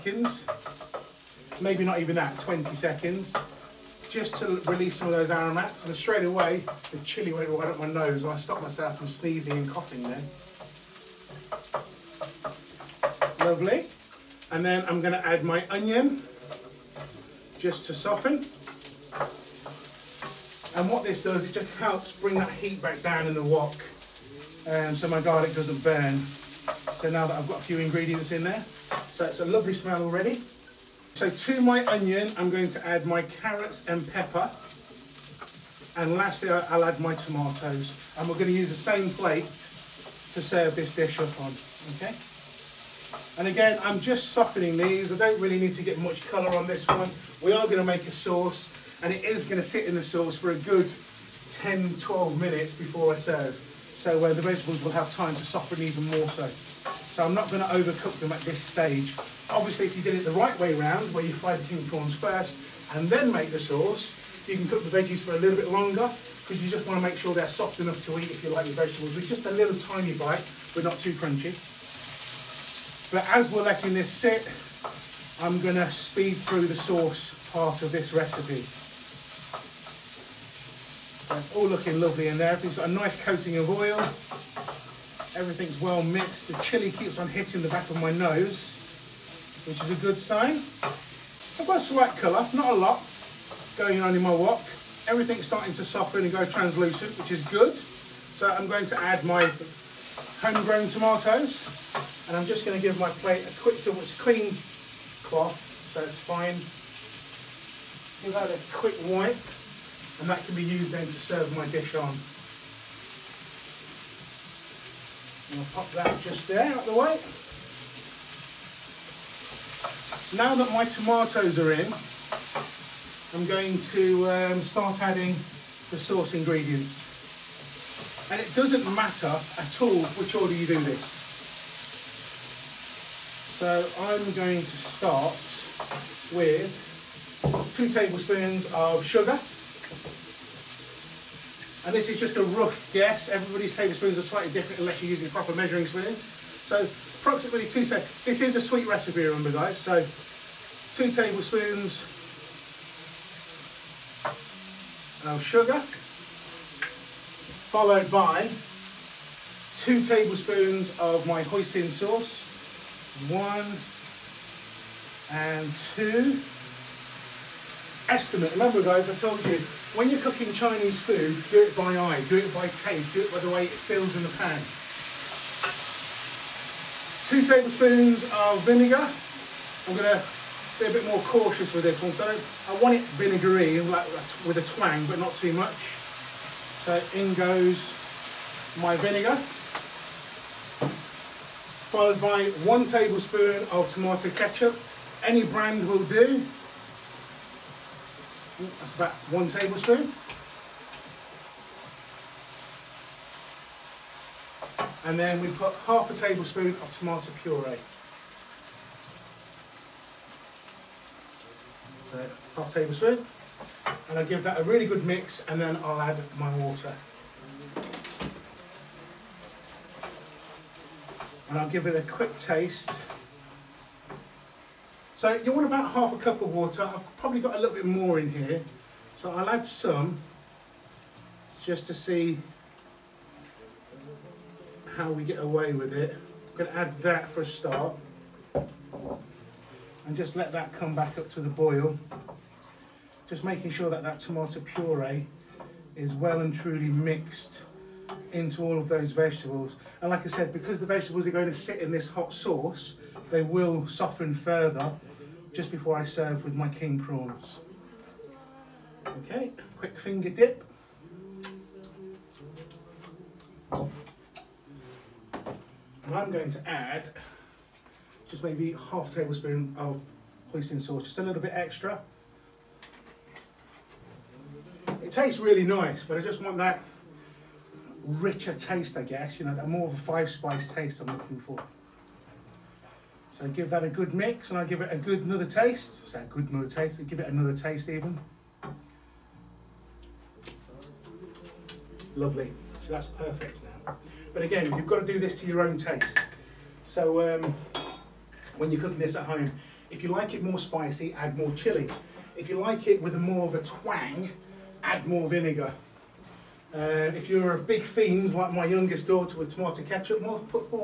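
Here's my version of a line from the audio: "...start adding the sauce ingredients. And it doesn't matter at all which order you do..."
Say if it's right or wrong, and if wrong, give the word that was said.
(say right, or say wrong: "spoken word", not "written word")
right.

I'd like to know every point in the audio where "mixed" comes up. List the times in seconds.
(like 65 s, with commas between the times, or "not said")
86 s, 246 s.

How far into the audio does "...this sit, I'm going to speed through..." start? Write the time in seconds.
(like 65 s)
73 s.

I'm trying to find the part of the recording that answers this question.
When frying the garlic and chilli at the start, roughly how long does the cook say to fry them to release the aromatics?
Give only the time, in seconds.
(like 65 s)
2 s.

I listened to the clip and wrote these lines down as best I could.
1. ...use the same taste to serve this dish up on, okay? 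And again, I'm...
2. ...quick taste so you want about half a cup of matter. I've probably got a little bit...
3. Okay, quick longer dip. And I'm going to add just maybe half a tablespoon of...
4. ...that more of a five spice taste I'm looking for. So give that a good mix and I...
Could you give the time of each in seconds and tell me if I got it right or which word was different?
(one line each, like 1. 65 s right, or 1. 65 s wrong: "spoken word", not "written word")
1. 38 s wrong: "plate", not "taste"
2. 222 s wrong: "water", not "matter"
3. 259 s wrong: "finger", not "longer"
4. 279 s right.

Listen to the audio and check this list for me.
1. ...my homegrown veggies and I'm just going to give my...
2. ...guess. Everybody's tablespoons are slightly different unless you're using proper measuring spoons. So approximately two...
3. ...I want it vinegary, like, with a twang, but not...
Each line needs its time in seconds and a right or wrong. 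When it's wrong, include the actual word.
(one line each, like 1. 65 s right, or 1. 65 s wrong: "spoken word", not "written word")
1. 99 s wrong: "tomatoes", not "veggies"
2. 142 s right
3. 182 s right.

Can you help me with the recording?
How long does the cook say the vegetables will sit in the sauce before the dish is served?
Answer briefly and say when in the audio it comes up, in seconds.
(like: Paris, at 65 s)
10, 12 minutes, at 51 s.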